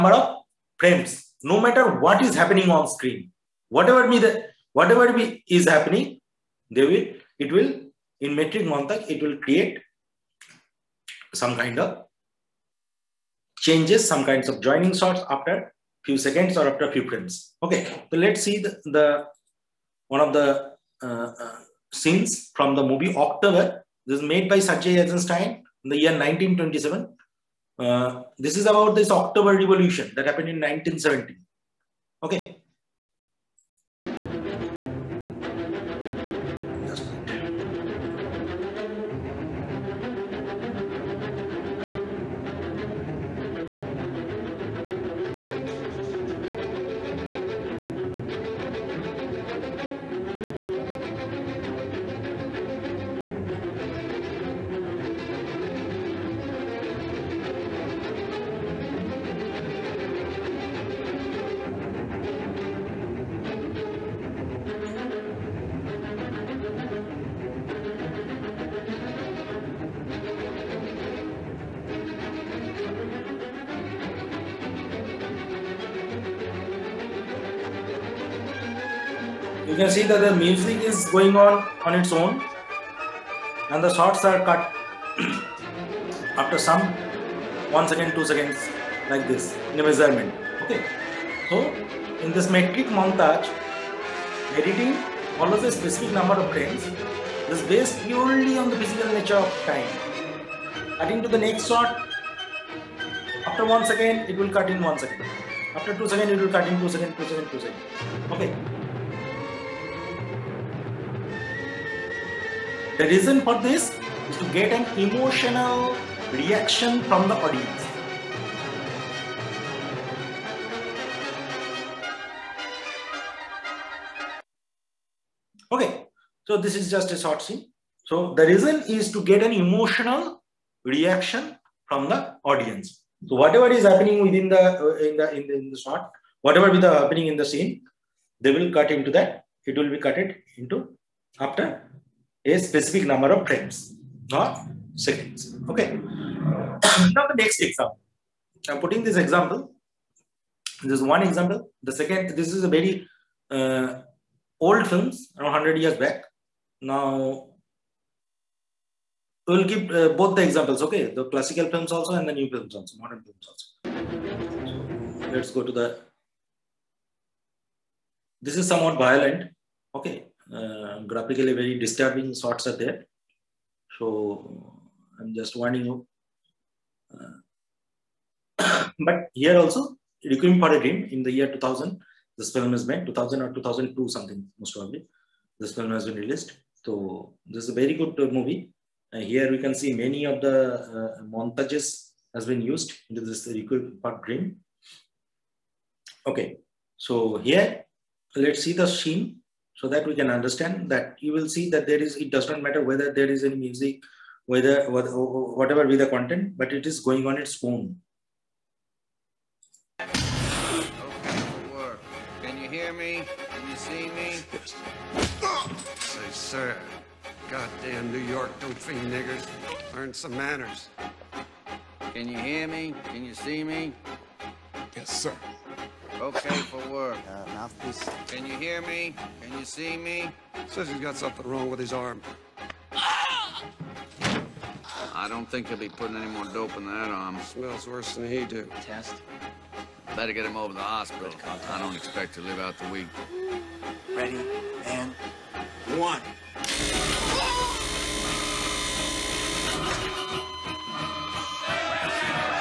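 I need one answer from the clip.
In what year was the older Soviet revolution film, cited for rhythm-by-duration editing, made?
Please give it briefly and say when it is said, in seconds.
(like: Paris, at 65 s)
1927, at 26 s.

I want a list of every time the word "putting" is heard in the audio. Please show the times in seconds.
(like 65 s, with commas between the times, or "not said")
148 s, 235 s.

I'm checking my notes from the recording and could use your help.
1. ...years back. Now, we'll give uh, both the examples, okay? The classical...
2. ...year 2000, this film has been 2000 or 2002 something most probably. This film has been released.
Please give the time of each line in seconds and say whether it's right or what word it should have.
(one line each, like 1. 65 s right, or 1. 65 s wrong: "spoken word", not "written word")
1. 155 s right
2. 181 s right.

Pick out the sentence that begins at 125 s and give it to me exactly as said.
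Okay, so this is just a short scene.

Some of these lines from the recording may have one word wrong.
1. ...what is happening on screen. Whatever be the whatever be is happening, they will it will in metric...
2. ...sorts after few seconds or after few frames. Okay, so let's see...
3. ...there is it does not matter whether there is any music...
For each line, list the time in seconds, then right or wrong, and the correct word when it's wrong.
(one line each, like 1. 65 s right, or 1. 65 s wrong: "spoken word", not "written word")
1. 1 s right
2. 14 s right
3. 201 s right.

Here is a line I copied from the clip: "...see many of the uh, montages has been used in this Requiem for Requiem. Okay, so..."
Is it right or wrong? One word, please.
wrong.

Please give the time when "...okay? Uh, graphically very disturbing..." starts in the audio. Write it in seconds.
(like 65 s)
169 s.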